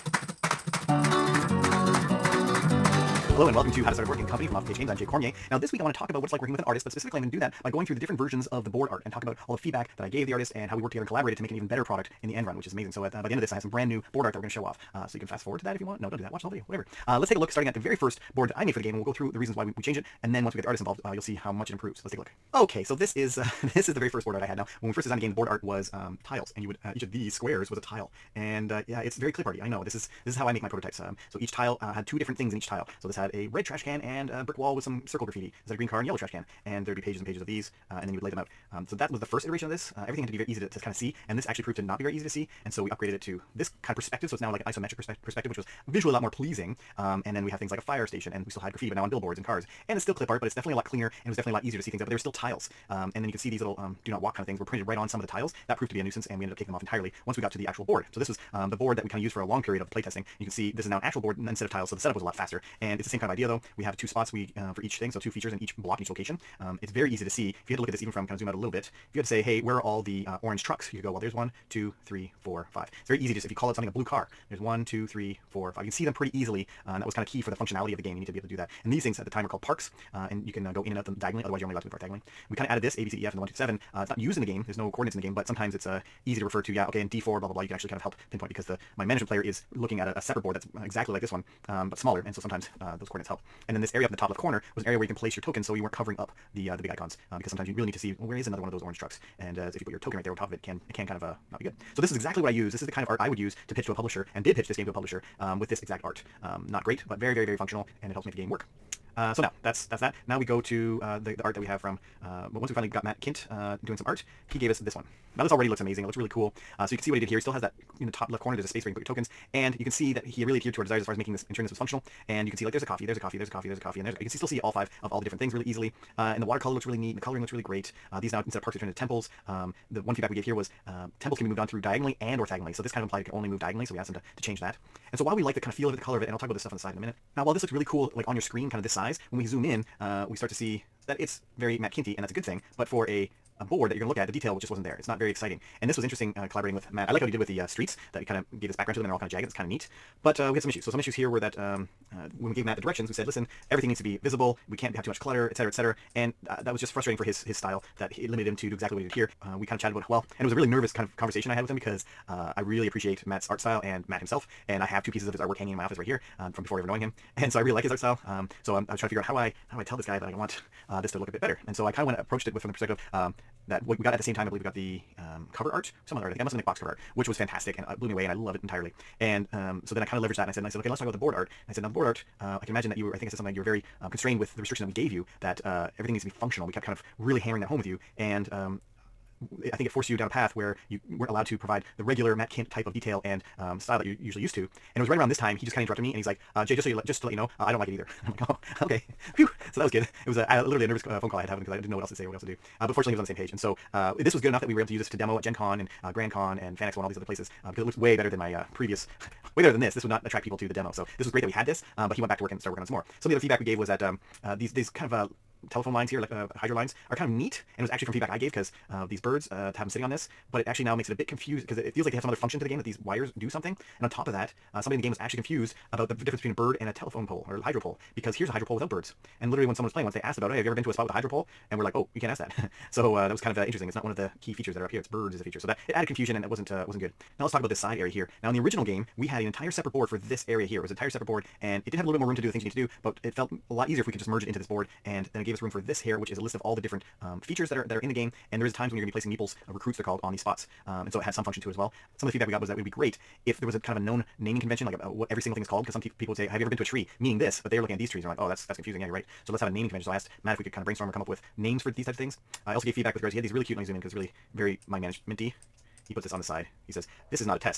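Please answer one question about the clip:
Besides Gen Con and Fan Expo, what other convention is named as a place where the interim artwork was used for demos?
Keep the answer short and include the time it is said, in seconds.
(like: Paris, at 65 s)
GrandCon, at 206 s.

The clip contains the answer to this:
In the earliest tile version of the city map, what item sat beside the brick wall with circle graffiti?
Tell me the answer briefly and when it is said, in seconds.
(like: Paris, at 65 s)
red trash can, at 33 s.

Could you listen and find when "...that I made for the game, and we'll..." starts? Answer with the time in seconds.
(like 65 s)
18 s.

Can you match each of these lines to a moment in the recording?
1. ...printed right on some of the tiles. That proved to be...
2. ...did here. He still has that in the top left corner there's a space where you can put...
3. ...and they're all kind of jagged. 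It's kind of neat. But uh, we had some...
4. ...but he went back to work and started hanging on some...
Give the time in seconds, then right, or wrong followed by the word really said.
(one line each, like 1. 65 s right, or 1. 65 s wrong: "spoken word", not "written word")
1. 54 s right
2. 117 s right
3. 149 s right
4. 212 s wrong: "working", not "hanging".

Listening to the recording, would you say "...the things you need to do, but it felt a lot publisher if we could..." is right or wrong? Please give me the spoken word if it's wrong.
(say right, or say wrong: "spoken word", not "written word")
wrong: "easier", not "publisher".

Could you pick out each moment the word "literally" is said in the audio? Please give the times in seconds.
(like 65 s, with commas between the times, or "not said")
200 s, 229 s.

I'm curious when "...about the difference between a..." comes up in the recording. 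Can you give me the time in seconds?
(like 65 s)
225 s.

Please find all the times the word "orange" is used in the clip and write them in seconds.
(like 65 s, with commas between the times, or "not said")
70 s, 98 s.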